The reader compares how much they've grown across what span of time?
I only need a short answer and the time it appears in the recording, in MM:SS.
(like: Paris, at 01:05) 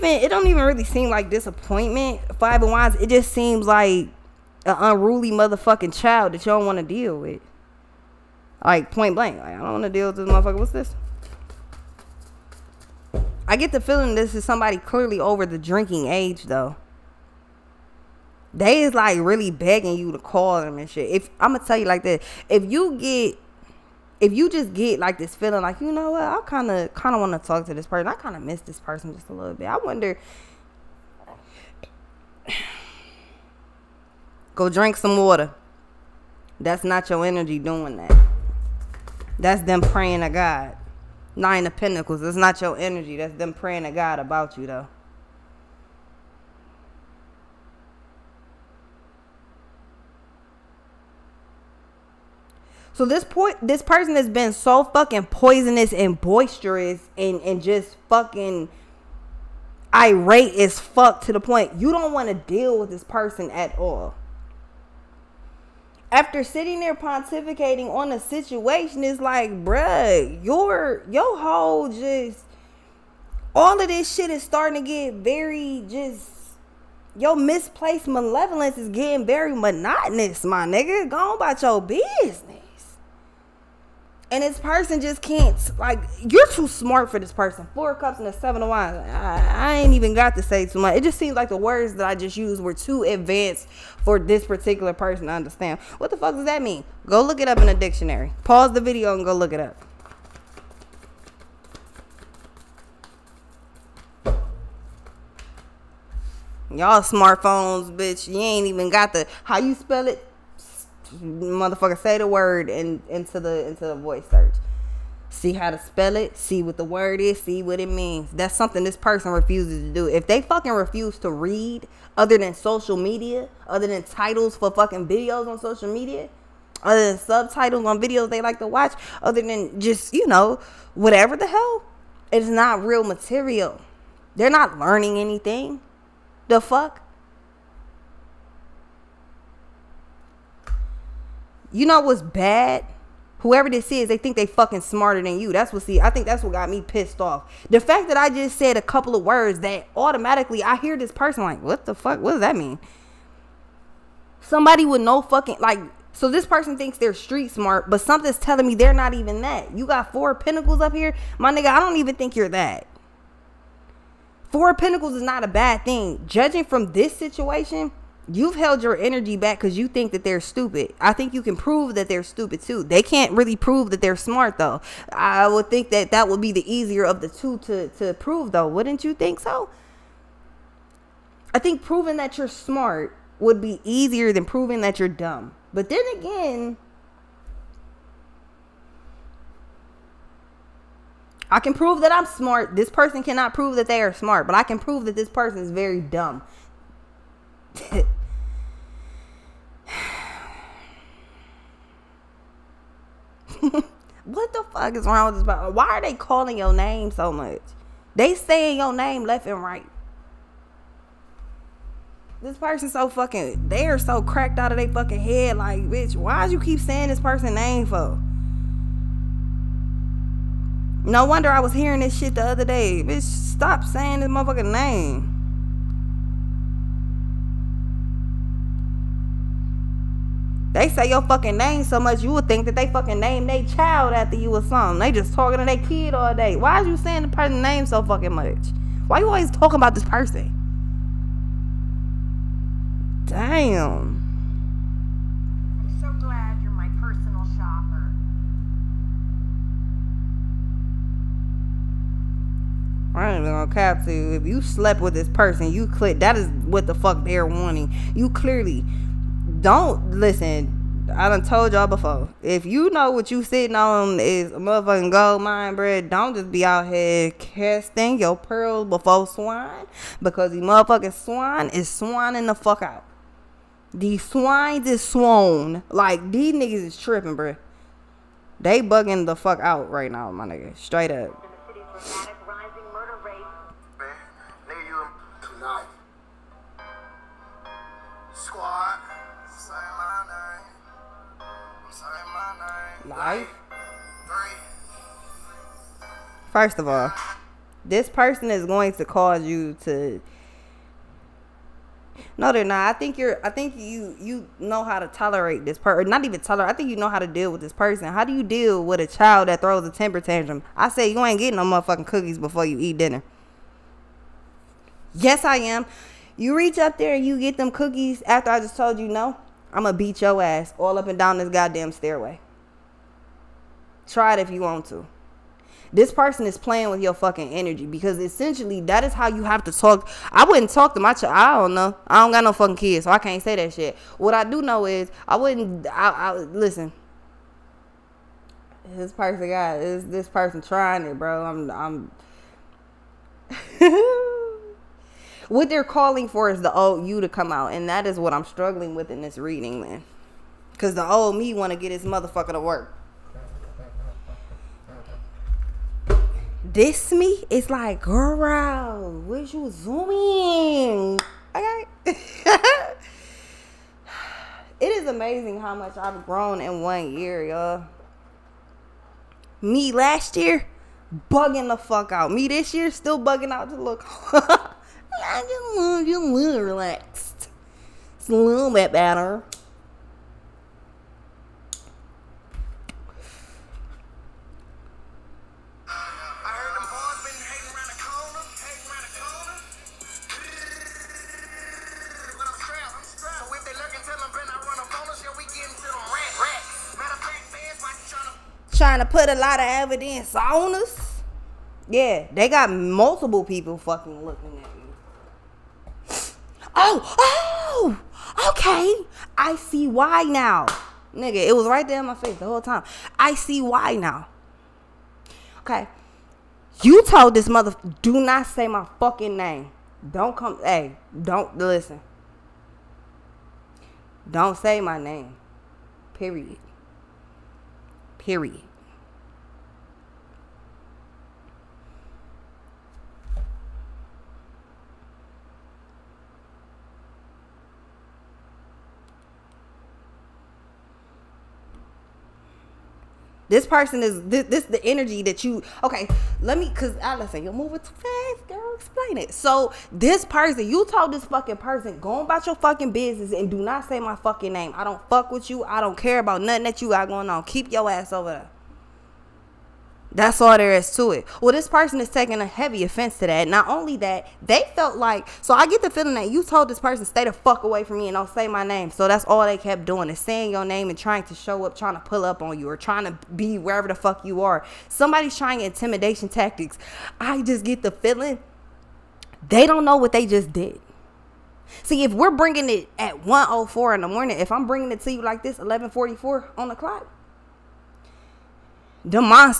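One year, at 06:06.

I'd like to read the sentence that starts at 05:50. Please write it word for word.
because the old me want to get his motherfucker to work This me, is like, girl, where's you zooming?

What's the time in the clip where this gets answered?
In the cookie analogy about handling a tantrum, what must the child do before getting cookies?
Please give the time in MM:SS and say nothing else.
05:12.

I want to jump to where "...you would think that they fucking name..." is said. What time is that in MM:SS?
03:52.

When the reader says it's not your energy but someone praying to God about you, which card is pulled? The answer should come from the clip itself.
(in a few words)
Nine of Pentacles.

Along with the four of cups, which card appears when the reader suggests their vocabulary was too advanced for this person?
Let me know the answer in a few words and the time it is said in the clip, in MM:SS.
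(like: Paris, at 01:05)
Seven of Wands, at 01:28.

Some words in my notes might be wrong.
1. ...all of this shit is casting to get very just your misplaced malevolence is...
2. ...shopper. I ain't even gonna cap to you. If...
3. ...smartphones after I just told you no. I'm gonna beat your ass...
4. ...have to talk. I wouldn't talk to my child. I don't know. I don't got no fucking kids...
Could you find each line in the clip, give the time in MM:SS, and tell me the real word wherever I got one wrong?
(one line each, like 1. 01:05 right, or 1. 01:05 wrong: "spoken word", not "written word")
1. 01:13 wrong: "starting", not "casting"
2. 04:07 right
3. 05:17 wrong: "cookies", not "smartphones"
4. 05:29 right.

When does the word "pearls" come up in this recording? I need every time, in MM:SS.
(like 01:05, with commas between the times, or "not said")
04:28.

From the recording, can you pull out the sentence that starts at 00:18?
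They is like really begging you to call them and shit.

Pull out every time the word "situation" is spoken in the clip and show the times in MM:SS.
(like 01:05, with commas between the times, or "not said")
01:08, 02:47.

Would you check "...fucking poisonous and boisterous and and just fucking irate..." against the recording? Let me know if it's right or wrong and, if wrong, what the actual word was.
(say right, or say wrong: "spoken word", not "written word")
right.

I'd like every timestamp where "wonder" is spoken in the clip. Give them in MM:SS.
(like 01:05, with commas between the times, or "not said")
00:29, 03:41.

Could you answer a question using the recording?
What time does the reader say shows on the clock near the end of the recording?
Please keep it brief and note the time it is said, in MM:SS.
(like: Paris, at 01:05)
11:44, at 08:05.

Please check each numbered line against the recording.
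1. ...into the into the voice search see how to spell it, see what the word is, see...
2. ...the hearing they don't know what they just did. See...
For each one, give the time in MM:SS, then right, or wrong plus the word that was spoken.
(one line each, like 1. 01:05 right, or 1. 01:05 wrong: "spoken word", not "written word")
1. 01:53 right
2. 07:57 wrong: "feeling", not "hearing".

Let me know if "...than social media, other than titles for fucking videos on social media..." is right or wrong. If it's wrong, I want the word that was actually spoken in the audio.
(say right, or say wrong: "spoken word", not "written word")
right.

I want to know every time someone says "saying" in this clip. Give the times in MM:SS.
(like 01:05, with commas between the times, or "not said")
03:28, 03:36, 03:43, 03:56, 07:50.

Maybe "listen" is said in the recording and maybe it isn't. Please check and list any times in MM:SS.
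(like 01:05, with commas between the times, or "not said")
04:20, 05:36, 07:01, 07:27.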